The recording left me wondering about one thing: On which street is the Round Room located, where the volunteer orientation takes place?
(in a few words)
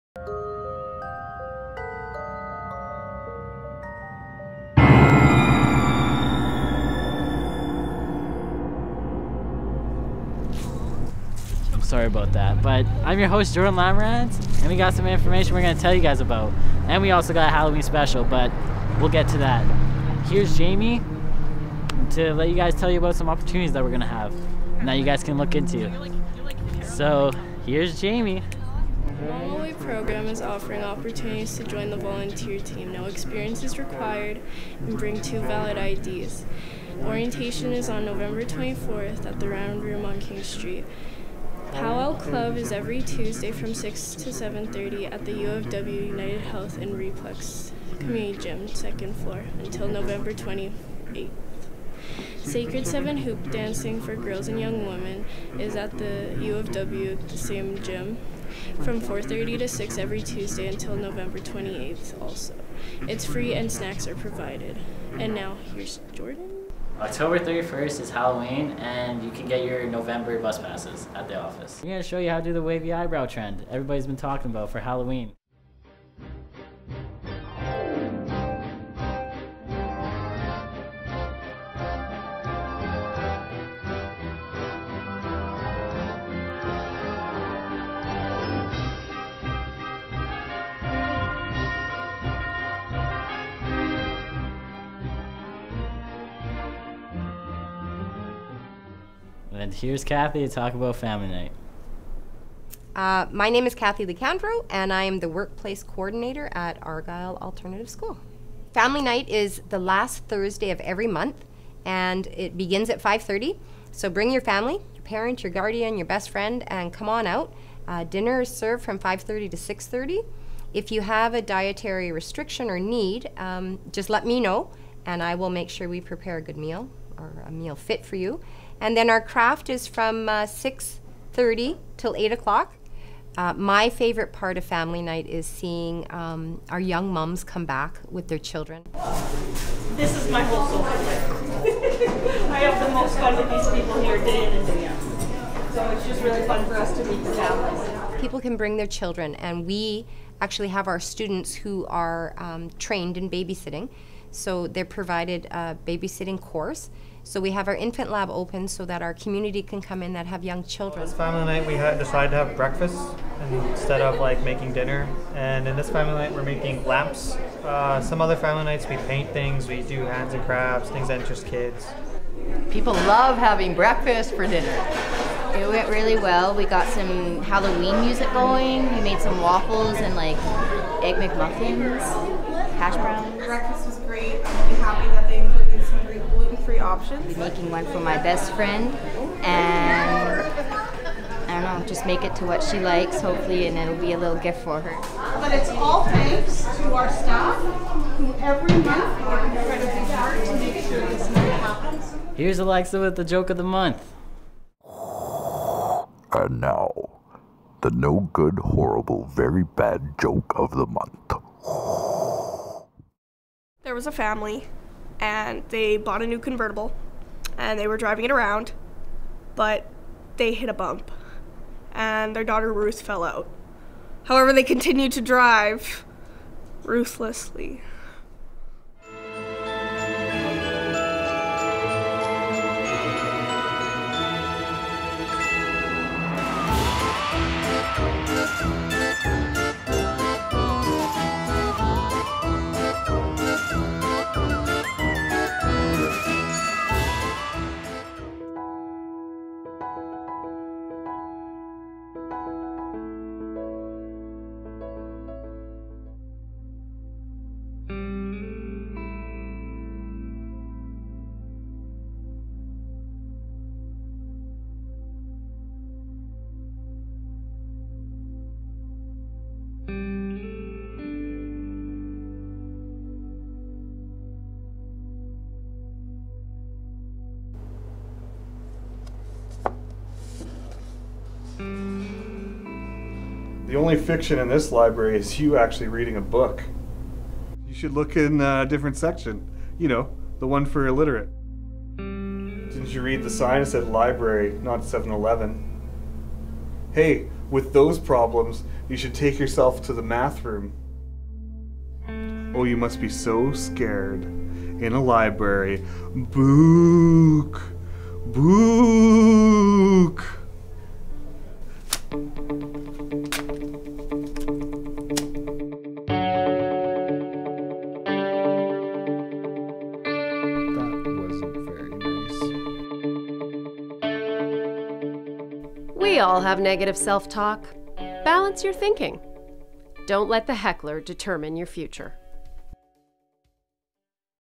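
King Street.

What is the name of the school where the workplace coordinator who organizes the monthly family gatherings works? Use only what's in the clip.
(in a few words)
Argyle Alternative School.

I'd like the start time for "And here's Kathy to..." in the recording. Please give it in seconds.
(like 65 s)
99 s.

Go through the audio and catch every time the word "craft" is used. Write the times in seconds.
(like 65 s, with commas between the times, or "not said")
129 s, 170 s.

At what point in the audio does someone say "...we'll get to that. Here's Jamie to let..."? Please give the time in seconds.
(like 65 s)
19 s.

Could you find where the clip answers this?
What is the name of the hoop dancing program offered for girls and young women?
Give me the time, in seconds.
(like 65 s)
52 s.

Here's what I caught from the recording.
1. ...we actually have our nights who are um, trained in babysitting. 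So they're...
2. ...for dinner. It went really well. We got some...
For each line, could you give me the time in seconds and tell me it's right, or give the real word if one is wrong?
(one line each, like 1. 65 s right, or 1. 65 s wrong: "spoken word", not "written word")
1. 149 s wrong: "students", not "nights"
2. 174 s right.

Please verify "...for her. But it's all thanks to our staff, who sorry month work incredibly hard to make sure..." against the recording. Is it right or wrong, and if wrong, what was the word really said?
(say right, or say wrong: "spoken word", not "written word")
wrong: "every", not "sorry".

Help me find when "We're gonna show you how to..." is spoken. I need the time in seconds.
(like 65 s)
71 s.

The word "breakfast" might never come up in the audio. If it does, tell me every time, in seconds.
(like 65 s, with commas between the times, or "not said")
162 s, 173 s, 183 s.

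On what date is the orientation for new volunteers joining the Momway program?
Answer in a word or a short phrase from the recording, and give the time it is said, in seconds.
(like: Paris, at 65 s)
November 24th, at 38 s.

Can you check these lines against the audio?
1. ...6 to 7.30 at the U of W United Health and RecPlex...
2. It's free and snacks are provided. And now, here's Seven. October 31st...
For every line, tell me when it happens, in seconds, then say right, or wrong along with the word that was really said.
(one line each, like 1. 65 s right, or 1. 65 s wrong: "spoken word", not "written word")
1. 43 s right
2. 63 s wrong: "Jordan", not "Seven".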